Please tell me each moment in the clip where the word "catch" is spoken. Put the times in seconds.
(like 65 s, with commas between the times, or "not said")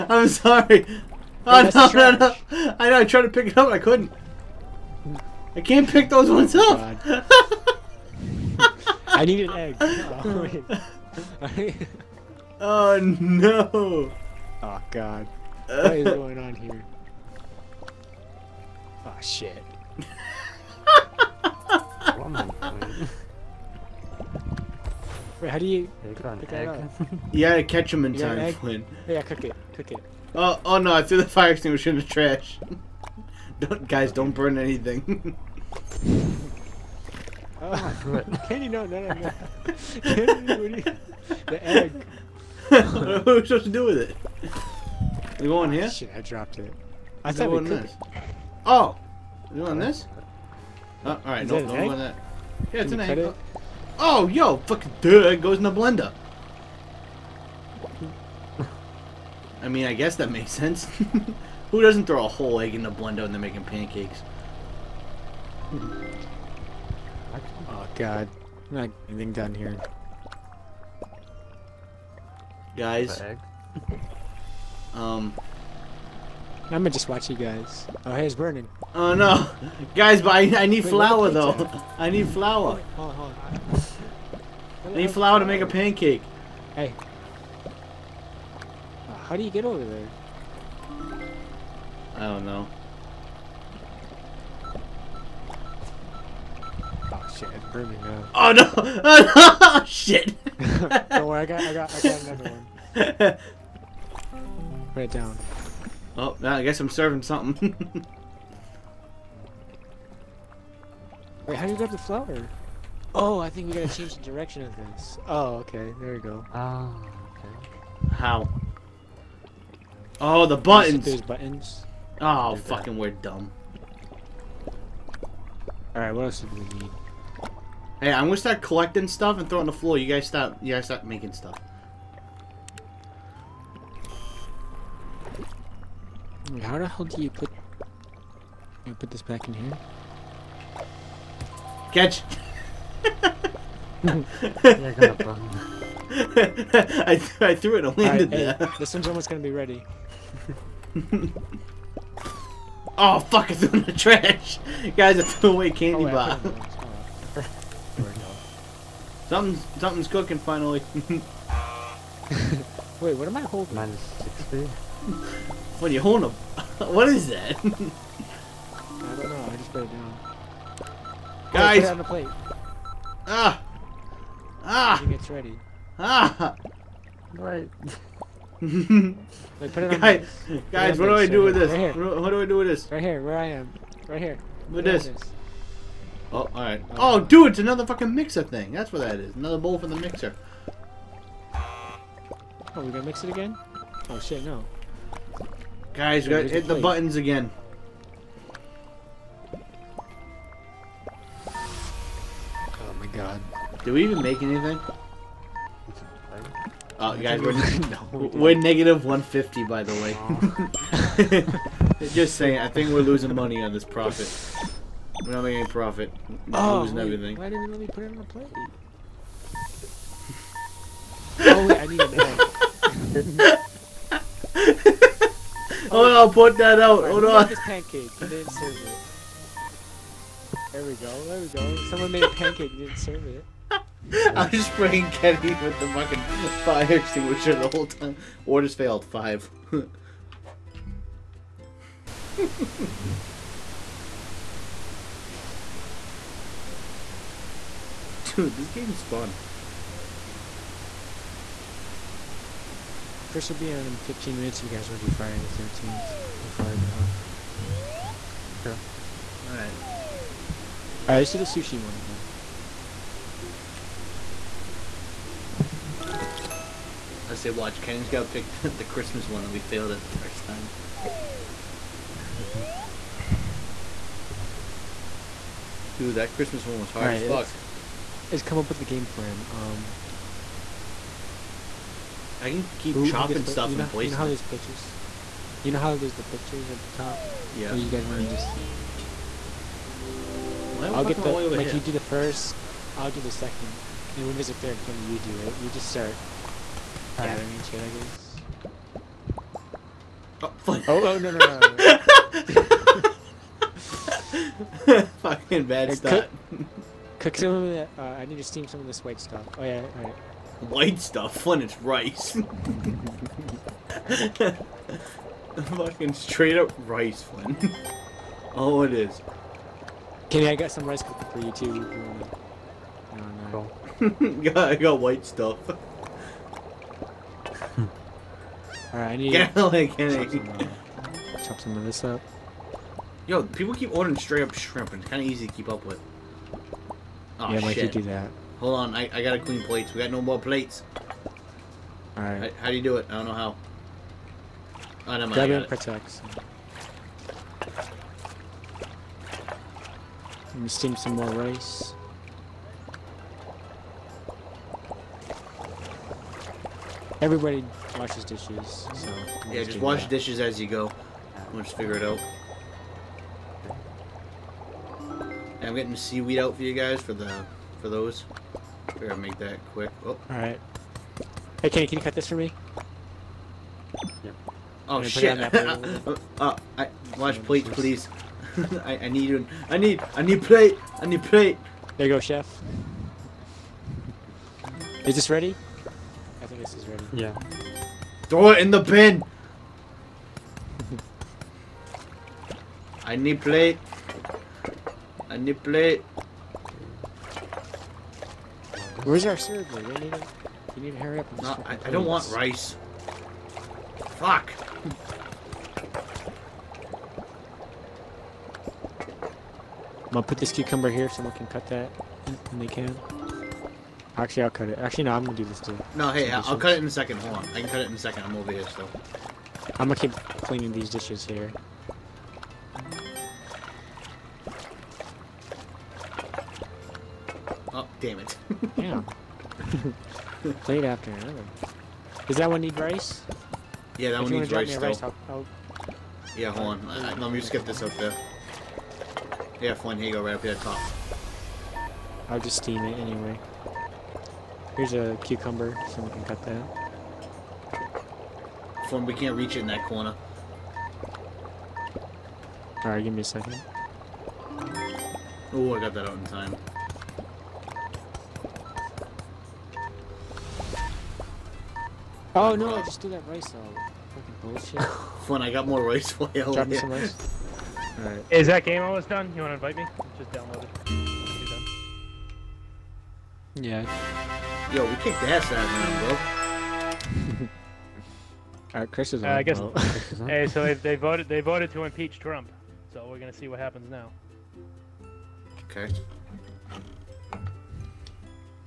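27 s, 141 s.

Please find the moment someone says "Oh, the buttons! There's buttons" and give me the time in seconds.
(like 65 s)
120 s.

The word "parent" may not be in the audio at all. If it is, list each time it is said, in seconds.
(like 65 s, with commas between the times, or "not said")
not said.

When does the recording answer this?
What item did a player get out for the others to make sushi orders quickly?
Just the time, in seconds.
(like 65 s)
365 s.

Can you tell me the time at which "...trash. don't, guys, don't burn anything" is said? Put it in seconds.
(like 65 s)
32 s.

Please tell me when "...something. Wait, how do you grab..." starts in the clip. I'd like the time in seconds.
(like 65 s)
107 s.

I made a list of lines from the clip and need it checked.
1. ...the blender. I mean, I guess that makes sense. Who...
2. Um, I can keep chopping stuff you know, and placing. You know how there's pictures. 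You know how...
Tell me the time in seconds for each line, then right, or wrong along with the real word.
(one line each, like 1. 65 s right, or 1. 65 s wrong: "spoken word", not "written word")
1. 55 s right
2. 279 s right.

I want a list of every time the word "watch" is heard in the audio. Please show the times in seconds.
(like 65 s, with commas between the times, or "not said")
77 s, 267 s, 377 s.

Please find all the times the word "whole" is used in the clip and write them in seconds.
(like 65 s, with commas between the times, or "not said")
62 s, 237 s.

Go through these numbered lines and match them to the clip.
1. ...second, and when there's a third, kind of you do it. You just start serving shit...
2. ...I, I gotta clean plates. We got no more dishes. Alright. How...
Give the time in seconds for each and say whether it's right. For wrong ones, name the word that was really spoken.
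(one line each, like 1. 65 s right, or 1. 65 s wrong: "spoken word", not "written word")
1. 293 s wrong: "gathering", not "serving"
2. 338 s wrong: "plates", not "dishes".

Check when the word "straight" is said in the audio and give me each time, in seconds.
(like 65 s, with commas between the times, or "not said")
316 s, 334 s.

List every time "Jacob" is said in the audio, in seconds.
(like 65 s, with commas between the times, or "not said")
not said.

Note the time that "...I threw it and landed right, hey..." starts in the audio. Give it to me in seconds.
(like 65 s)
147 s.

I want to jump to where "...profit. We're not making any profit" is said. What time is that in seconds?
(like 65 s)
213 s.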